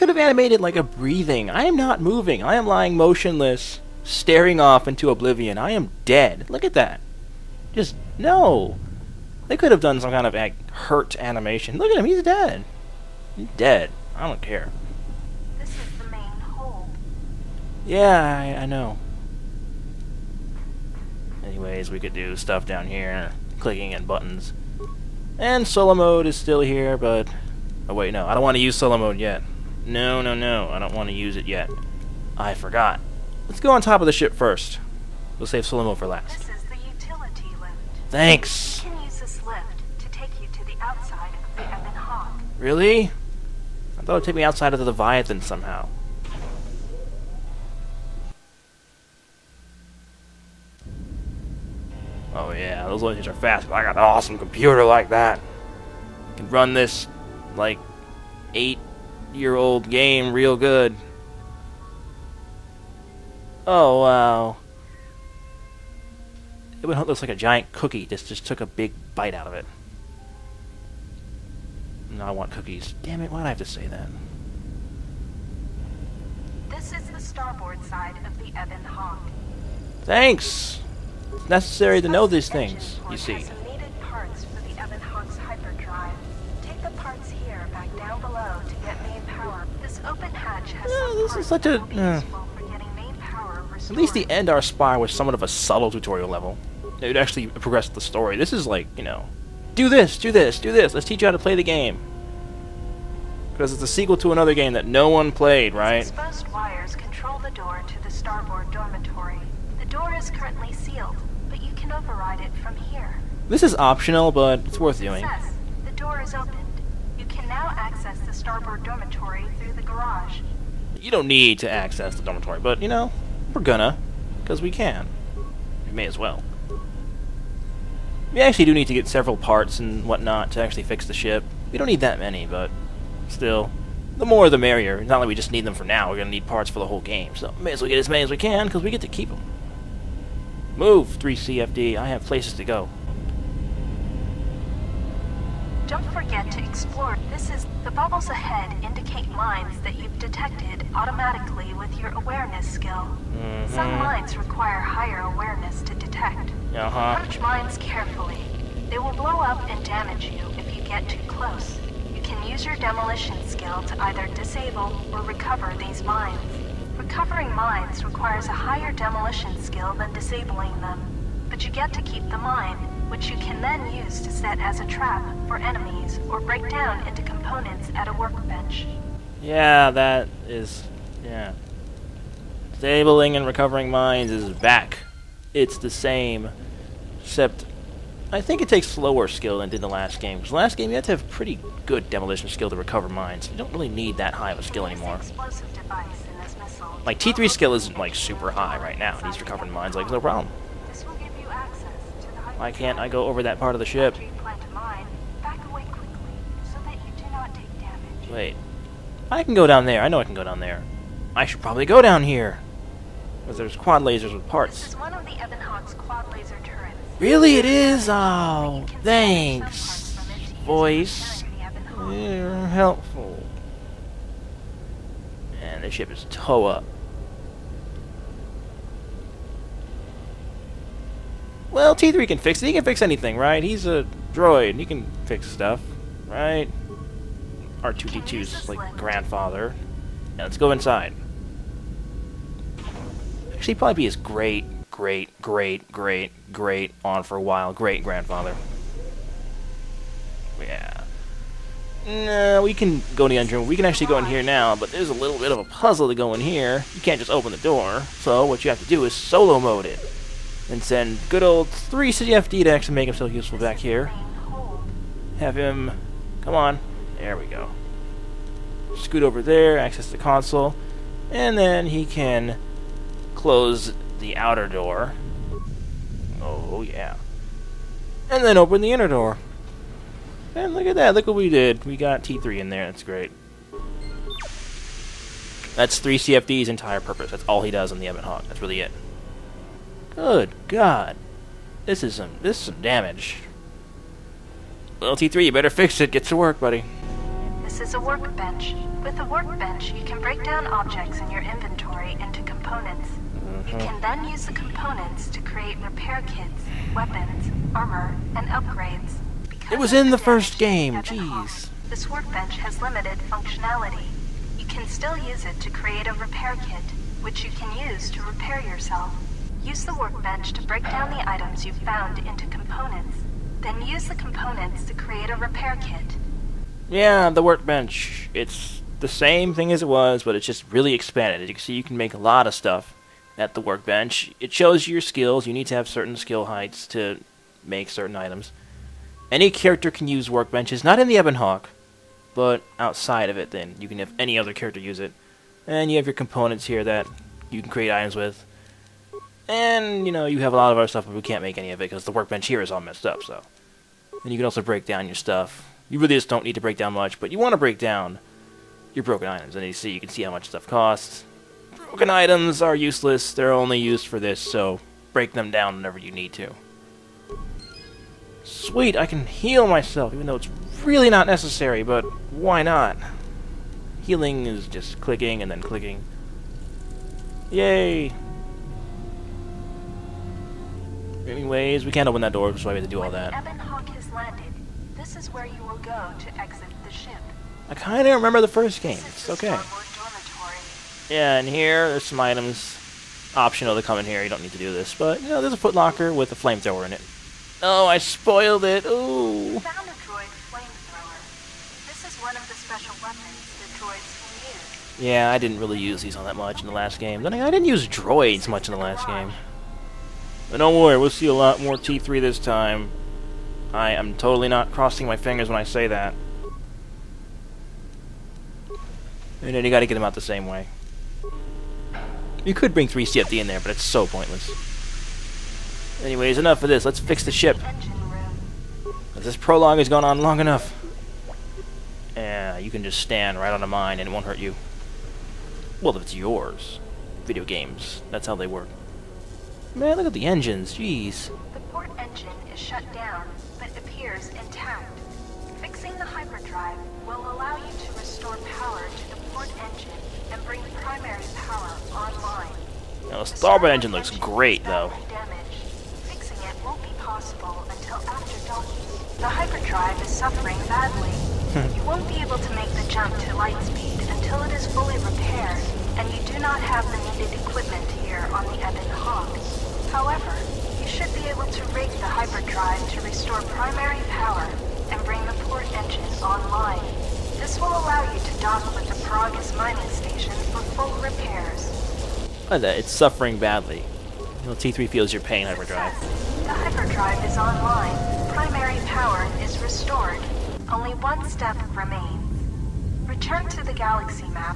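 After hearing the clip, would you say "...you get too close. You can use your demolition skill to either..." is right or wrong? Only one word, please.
right.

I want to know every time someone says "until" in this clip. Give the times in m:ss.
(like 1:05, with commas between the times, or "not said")
7:37, 7:44.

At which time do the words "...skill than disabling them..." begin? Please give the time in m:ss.
2:49.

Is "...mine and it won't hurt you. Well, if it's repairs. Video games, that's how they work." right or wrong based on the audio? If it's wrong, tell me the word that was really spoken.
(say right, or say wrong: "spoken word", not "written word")
wrong: "yours", not "repairs".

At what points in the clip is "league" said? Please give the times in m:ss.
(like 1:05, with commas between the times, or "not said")
not said.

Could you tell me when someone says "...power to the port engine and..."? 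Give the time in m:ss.
7:28.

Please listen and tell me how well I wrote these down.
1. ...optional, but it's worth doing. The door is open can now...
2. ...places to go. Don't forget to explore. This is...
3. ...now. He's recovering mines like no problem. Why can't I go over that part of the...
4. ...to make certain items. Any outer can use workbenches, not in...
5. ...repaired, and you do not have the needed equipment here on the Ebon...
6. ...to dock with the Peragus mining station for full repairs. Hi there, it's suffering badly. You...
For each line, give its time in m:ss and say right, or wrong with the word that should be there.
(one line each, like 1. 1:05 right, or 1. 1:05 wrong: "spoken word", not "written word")
1. 1:53 right
2. 2:22 right
3. 3:18 right
4. 5:36 wrong: "character", not "outer"
5. 7:44 right
6. 7:58 right.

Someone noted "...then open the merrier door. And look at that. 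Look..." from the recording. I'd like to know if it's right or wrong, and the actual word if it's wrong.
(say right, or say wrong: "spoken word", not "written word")
wrong: "inner", not "merrier".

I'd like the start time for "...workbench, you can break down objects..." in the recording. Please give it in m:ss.
4:59.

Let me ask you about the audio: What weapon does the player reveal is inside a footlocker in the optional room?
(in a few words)
A flamethrower.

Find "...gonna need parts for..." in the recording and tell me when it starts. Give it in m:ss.
2:16.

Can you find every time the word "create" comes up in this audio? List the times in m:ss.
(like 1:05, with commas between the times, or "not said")
5:05, 5:15, 5:24, 5:47.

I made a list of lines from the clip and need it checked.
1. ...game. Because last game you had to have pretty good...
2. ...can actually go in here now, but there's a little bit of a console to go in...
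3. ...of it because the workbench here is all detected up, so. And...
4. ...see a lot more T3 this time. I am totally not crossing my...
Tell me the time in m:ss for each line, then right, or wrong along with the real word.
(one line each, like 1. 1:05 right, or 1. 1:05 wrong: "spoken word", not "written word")
1. 3:10 right
2. 4:13 wrong: "puzzle", not "console"
3. 5:51 wrong: "messed", not "detected"
4. 6:51 right.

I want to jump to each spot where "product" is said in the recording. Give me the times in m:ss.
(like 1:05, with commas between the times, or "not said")
not said.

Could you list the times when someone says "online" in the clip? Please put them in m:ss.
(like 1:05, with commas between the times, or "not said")
7:31, 7:56, 8:07.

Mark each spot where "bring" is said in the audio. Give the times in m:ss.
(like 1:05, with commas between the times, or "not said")
7:02, 7:30, 7:55.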